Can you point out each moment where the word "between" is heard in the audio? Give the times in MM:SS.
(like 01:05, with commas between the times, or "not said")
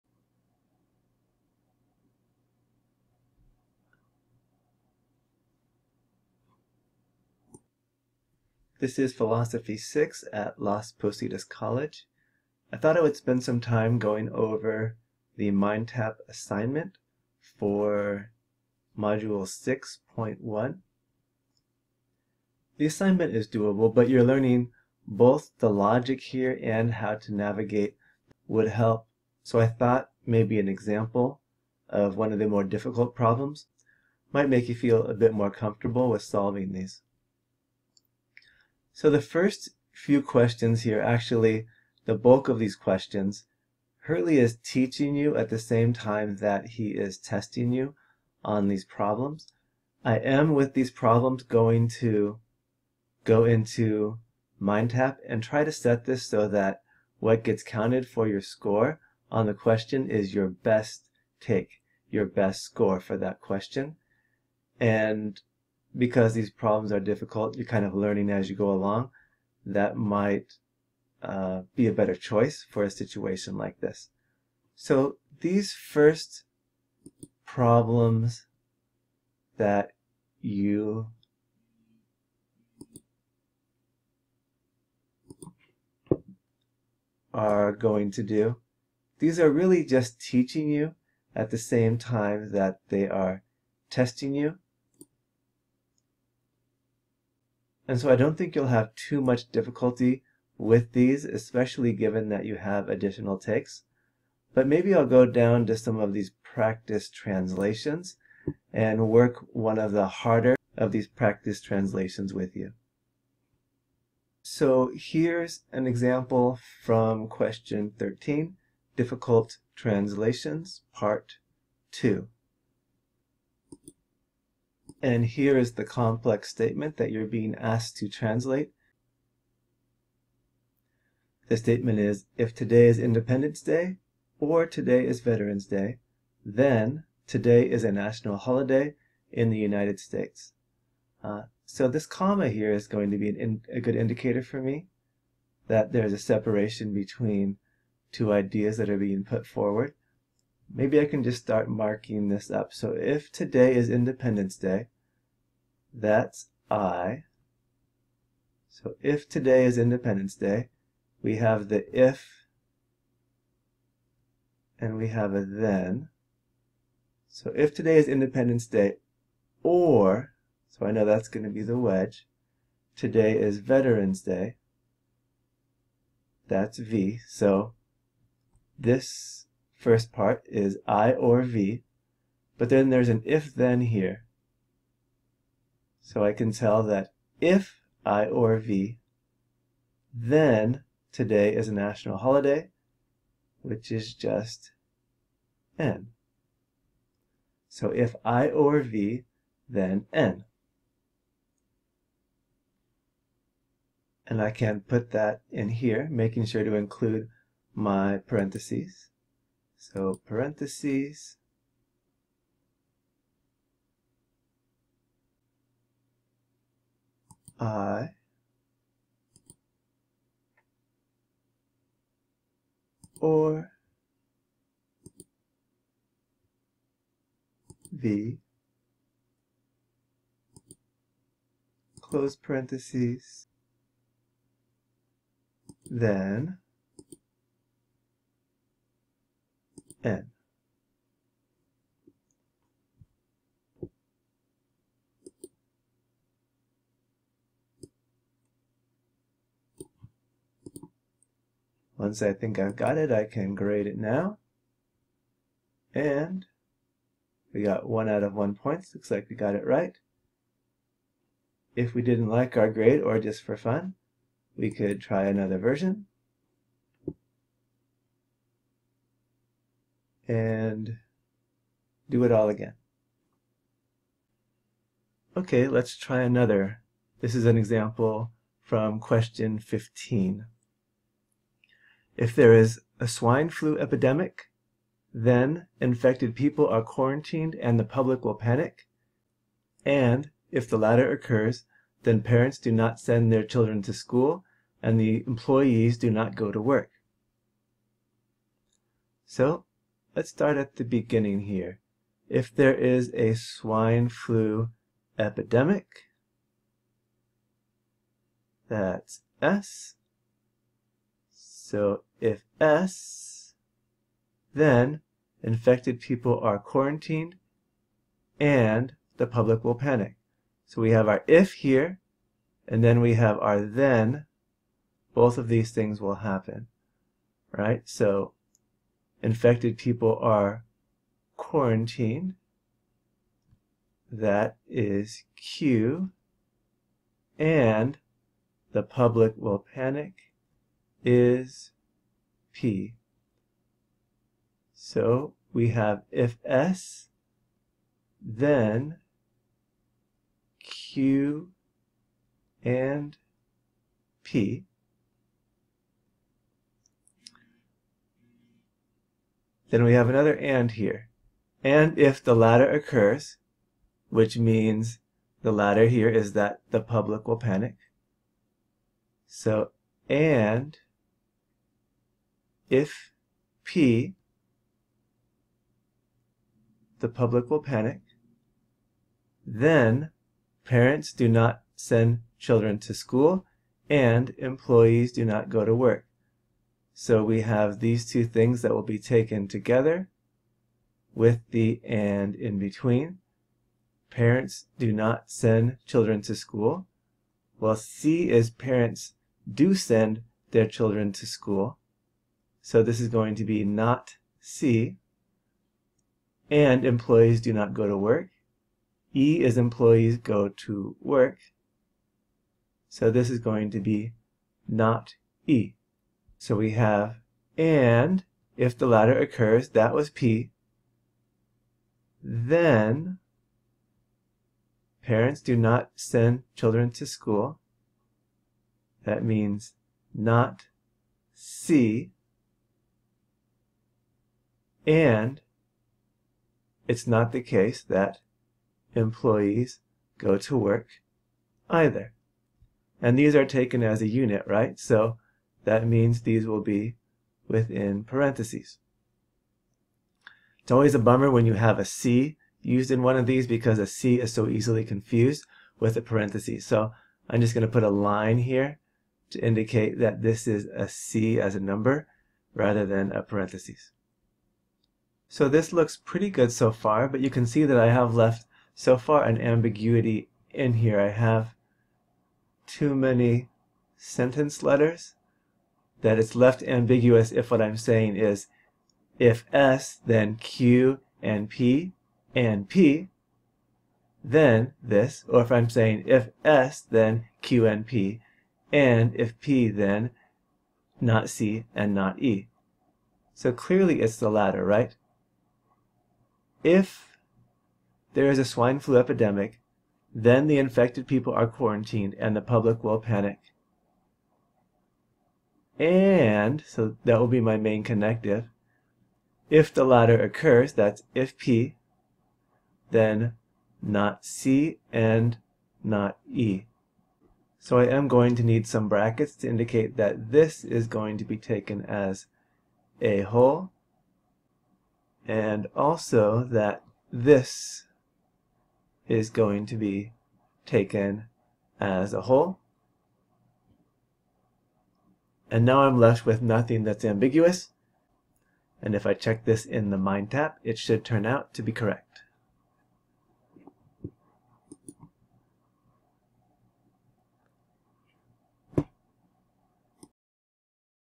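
02:26, 06:32.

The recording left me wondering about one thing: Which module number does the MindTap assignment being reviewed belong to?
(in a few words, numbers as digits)
6.1.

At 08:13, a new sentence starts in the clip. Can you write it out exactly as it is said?
So clearly it's the latter, right?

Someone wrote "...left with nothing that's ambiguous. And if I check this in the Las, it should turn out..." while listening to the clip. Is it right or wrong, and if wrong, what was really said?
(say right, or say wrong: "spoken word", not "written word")
wrong: "MindTap", not "Las".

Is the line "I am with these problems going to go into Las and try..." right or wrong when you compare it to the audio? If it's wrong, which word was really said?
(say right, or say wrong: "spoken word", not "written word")
wrong: "MindTap", not "Las".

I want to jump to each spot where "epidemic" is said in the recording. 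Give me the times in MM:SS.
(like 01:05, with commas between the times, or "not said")
04:43, 05:05, 08:18.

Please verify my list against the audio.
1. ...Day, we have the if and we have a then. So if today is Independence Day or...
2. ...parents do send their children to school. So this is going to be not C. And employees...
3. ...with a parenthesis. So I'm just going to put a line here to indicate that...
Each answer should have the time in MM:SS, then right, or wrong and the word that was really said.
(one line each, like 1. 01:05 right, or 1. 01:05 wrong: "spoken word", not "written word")
1. 02:40 right
2. 06:38 right
3. 07:35 right.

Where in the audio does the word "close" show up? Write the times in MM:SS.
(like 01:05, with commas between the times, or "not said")
03:52.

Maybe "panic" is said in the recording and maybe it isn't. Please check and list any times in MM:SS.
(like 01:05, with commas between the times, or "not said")
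04:48, 05:19, 05:39, 06:07, 06:17, 08:22.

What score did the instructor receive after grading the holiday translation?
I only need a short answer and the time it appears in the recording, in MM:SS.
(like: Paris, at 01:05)
1 out of 1, at 04:17.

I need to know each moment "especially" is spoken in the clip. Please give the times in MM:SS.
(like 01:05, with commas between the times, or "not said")
01:41.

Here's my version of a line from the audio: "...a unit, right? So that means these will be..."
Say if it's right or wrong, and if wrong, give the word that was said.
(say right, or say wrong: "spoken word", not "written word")
right.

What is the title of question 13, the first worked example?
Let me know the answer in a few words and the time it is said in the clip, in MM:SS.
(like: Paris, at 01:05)
Difficult Translations, Part 2, at 01:58.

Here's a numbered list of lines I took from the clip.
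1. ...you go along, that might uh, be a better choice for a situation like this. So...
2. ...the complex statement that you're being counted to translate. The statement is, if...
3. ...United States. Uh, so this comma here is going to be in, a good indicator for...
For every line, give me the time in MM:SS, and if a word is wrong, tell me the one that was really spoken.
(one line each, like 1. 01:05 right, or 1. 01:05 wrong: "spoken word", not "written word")
1. 01:08 right
2. 02:05 wrong: "asked", not "counted"
3. 02:19 right.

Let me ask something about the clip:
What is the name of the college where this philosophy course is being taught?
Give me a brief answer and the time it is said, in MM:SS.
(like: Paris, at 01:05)
Las Positas College, at 00:10.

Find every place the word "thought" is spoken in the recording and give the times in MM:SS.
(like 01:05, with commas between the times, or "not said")
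00:12, 00:29.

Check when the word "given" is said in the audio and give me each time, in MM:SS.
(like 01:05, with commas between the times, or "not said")
01:41.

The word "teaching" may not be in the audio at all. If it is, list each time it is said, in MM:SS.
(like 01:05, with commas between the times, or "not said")
00:44, 01:30.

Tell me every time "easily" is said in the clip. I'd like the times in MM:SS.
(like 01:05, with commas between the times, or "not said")
07:34.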